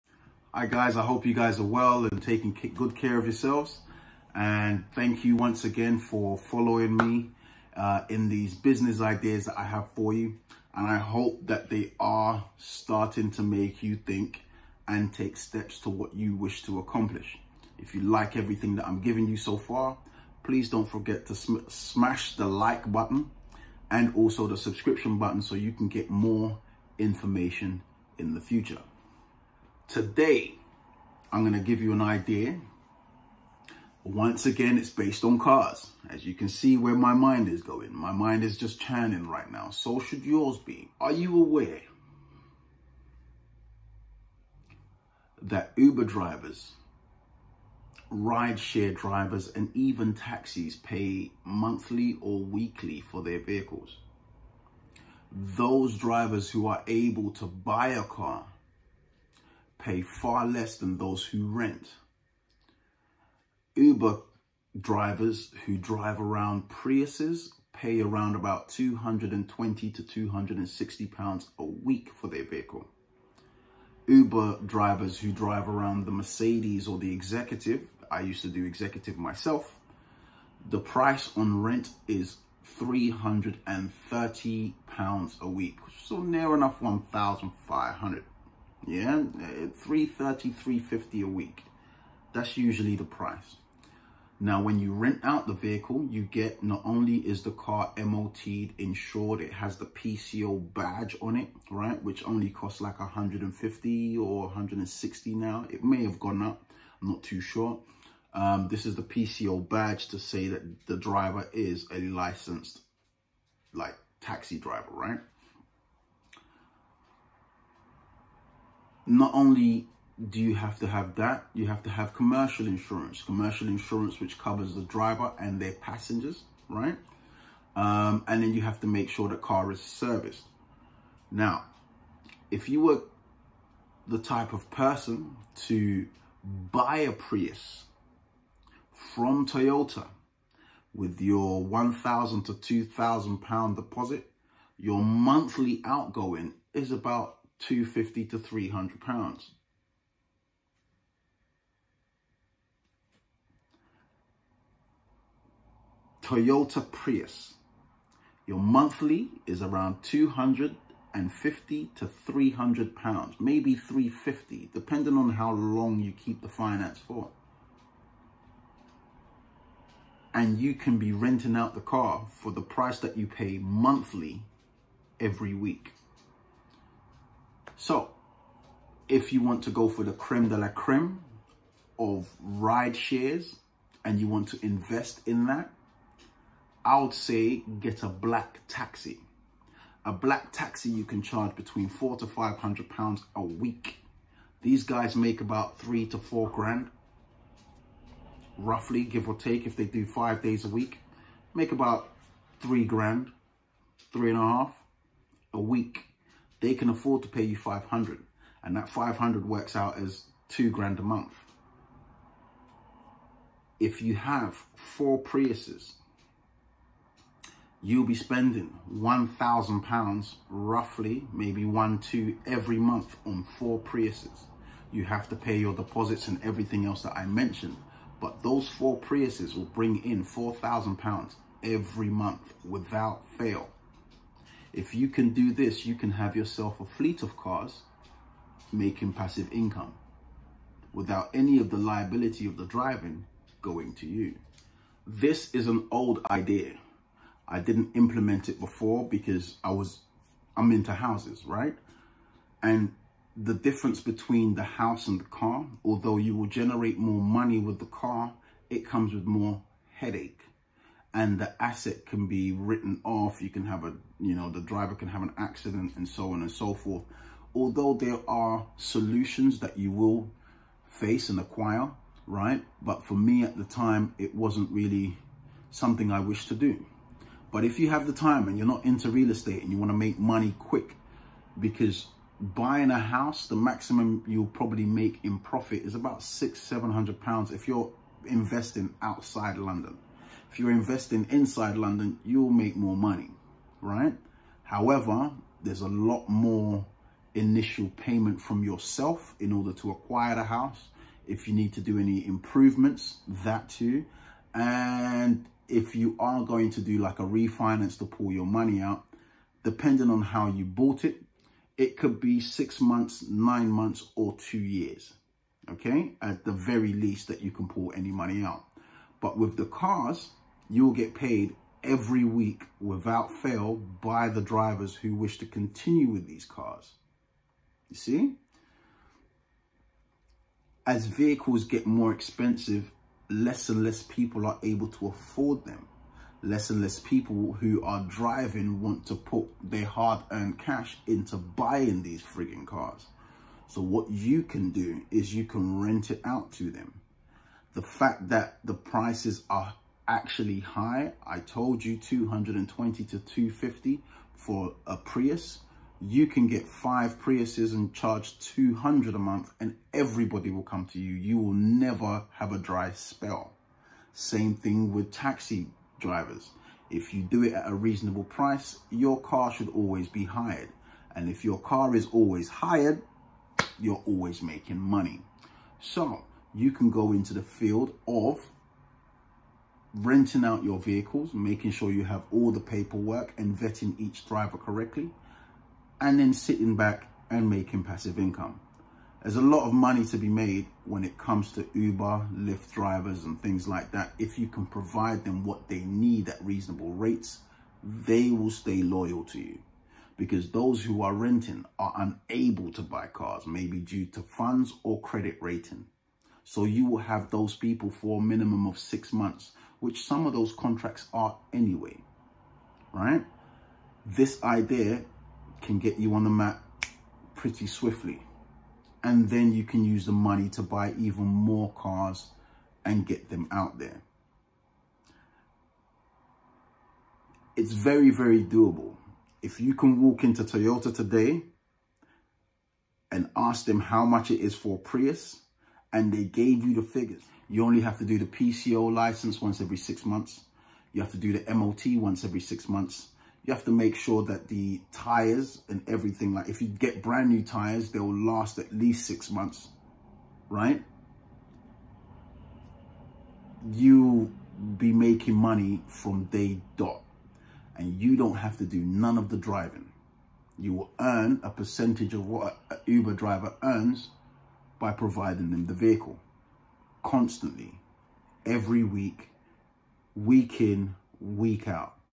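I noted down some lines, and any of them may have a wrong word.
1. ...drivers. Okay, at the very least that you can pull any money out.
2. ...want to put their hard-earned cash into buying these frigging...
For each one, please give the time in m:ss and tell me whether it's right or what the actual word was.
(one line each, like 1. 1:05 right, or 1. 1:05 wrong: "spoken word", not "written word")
1. 5:14 wrong: "years", not "drivers"
2. 5:38 right.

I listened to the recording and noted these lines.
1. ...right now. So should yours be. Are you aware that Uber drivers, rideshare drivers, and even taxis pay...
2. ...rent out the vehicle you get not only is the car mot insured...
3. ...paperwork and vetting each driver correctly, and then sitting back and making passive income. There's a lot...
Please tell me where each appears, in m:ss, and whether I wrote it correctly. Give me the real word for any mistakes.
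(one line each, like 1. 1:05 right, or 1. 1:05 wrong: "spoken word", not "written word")
1. 0:39 right
2. 1:34 right
3. 6:22 right.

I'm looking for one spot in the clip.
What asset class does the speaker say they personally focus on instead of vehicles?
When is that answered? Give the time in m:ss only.
4:10.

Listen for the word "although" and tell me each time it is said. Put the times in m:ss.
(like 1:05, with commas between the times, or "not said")
4:15, 4:27.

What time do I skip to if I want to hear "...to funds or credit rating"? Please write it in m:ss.
6:44.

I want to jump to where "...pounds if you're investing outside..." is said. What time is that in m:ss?
4:47.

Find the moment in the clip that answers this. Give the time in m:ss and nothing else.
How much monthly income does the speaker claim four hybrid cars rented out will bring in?
3:50.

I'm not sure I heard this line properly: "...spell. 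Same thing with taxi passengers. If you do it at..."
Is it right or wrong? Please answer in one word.
wrong.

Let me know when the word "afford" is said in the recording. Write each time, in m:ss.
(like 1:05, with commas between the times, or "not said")
3:26, 5:35.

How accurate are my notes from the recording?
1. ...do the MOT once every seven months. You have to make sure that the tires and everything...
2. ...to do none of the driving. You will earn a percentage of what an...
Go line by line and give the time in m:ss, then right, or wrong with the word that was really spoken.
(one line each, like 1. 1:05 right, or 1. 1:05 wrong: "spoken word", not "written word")
1. 7:21 wrong: "six", not "seven"
2. 7:38 right.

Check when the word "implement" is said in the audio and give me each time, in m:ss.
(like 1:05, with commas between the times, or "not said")
4:07.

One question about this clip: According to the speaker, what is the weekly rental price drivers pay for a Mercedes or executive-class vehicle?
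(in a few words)
330 pounds.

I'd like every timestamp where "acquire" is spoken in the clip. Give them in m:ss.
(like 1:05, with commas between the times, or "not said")
4:31, 4:59.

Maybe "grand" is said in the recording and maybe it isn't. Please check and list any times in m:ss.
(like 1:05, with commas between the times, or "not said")
3:16, 3:22, 3:30.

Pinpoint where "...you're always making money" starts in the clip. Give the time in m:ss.
6:13.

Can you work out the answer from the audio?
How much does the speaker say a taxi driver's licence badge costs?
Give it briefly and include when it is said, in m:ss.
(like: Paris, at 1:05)
150 or 160, at 1:42.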